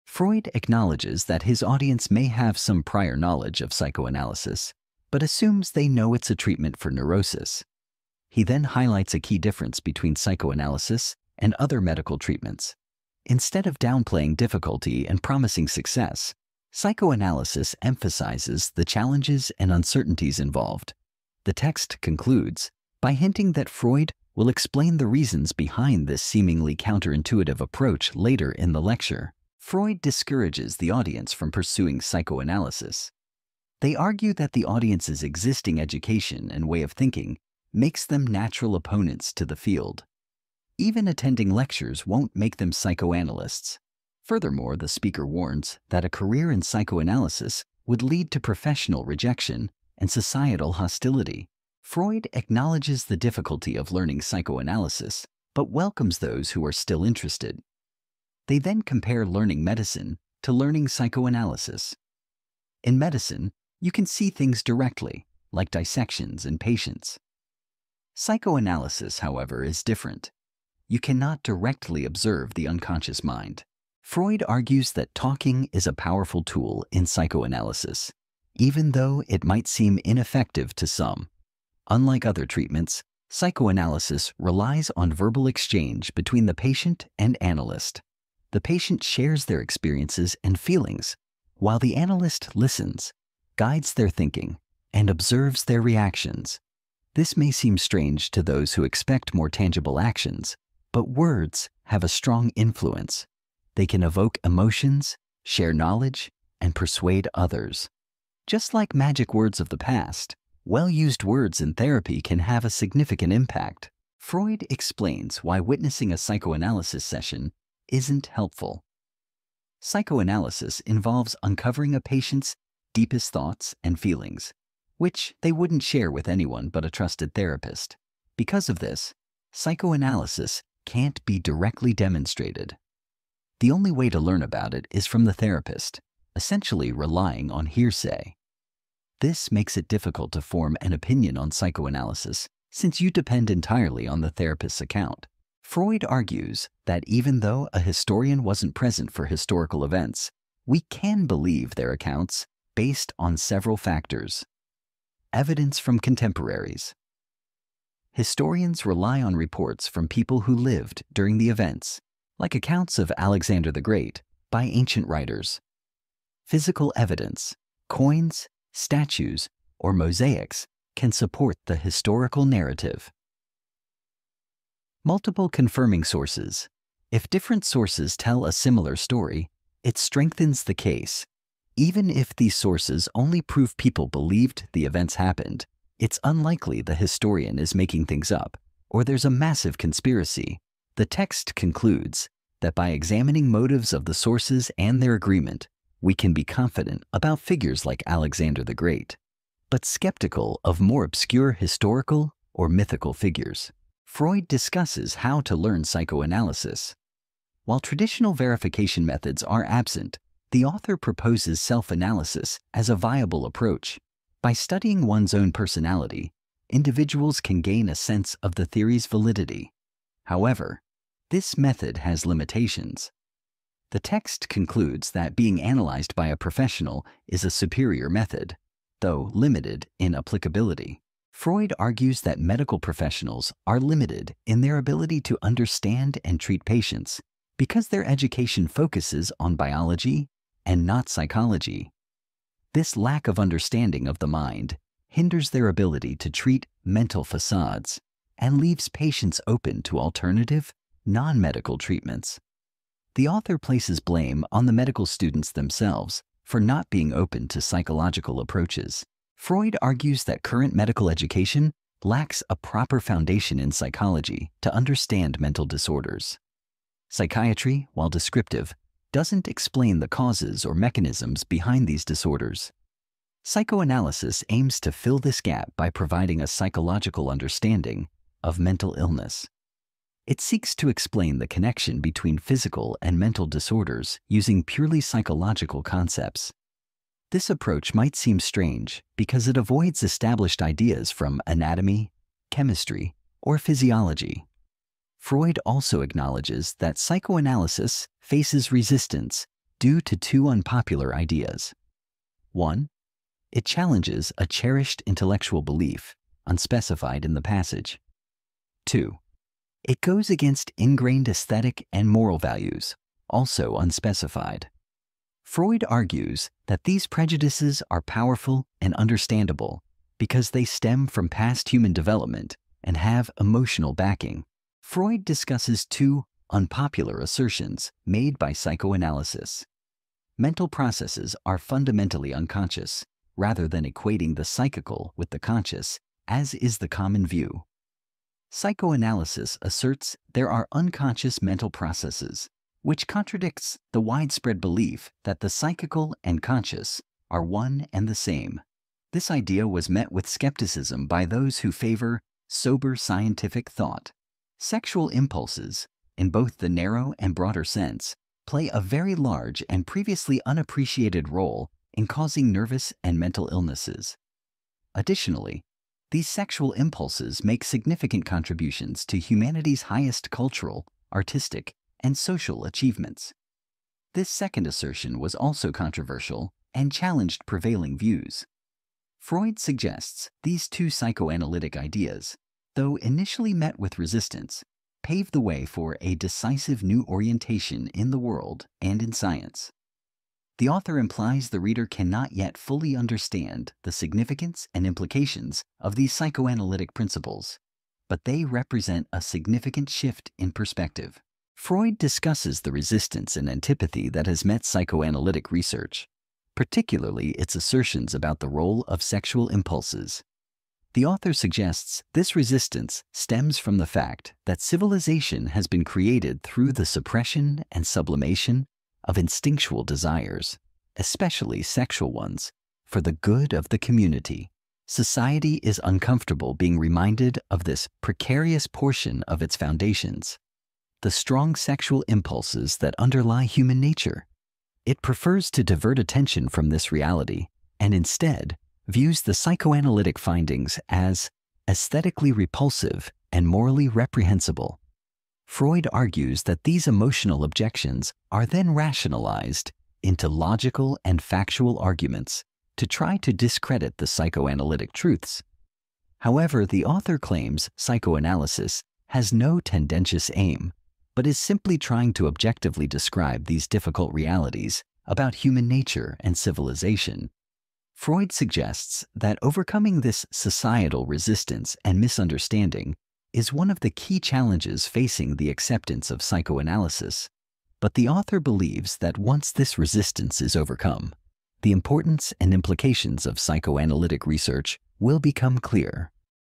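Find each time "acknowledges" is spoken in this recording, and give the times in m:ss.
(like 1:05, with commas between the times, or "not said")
0:00, 0:52, 4:56.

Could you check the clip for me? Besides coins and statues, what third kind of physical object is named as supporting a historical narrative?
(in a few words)
mosaics.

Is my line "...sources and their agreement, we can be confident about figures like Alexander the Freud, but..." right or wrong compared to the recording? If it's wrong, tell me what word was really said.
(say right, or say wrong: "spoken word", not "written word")
wrong: "Great", not "Freud".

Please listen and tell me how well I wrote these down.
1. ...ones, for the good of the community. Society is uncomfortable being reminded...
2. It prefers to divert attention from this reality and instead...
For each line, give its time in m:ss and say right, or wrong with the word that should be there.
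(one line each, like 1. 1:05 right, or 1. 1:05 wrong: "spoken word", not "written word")
1. 7:02 right
2. 7:14 right.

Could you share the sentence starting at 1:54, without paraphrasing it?
Freud explains why witnessing a psychoanalysis session isn't helpful.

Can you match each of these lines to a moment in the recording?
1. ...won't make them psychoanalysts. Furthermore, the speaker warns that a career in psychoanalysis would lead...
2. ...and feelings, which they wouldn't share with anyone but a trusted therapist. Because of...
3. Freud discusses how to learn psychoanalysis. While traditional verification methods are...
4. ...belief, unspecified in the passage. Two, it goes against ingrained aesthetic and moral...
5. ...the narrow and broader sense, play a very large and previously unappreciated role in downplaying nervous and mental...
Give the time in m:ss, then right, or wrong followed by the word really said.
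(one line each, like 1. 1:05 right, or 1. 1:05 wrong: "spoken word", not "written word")
1. 0:42 right
2. 2:03 right
3. 3:24 right
4. 5:05 right
5. 5:56 wrong: "causing", not "downplaying".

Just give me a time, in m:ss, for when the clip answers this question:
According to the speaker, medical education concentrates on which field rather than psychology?
3:59.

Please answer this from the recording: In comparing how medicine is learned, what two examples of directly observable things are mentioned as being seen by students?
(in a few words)
dissections and patients.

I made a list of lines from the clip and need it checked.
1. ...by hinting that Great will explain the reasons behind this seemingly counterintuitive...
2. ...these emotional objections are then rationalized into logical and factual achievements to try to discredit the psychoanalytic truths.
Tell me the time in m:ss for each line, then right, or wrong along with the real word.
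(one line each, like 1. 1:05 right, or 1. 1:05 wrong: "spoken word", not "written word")
1. 0:23 wrong: "Freud", not "Great"
2. 7:26 wrong: "arguments", not "achievements".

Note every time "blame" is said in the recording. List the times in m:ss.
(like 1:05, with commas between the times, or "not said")
4:13.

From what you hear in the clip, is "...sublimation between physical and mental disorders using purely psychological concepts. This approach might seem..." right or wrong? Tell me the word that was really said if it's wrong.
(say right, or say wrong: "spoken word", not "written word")
wrong: "connection", not "sublimation".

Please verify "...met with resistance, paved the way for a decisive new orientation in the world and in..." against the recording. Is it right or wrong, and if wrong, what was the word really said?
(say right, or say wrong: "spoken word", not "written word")
right.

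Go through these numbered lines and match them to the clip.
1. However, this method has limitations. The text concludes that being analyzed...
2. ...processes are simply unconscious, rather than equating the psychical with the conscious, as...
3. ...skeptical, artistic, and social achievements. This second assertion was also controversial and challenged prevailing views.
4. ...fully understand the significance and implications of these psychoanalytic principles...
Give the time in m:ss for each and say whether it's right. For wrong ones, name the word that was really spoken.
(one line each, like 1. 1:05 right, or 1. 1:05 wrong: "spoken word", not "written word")
1. 3:40 right
2. 5:30 wrong: "fundamentally", not "simply"
3. 6:10 wrong: "cultural", not "skeptical"
4. 6:32 right.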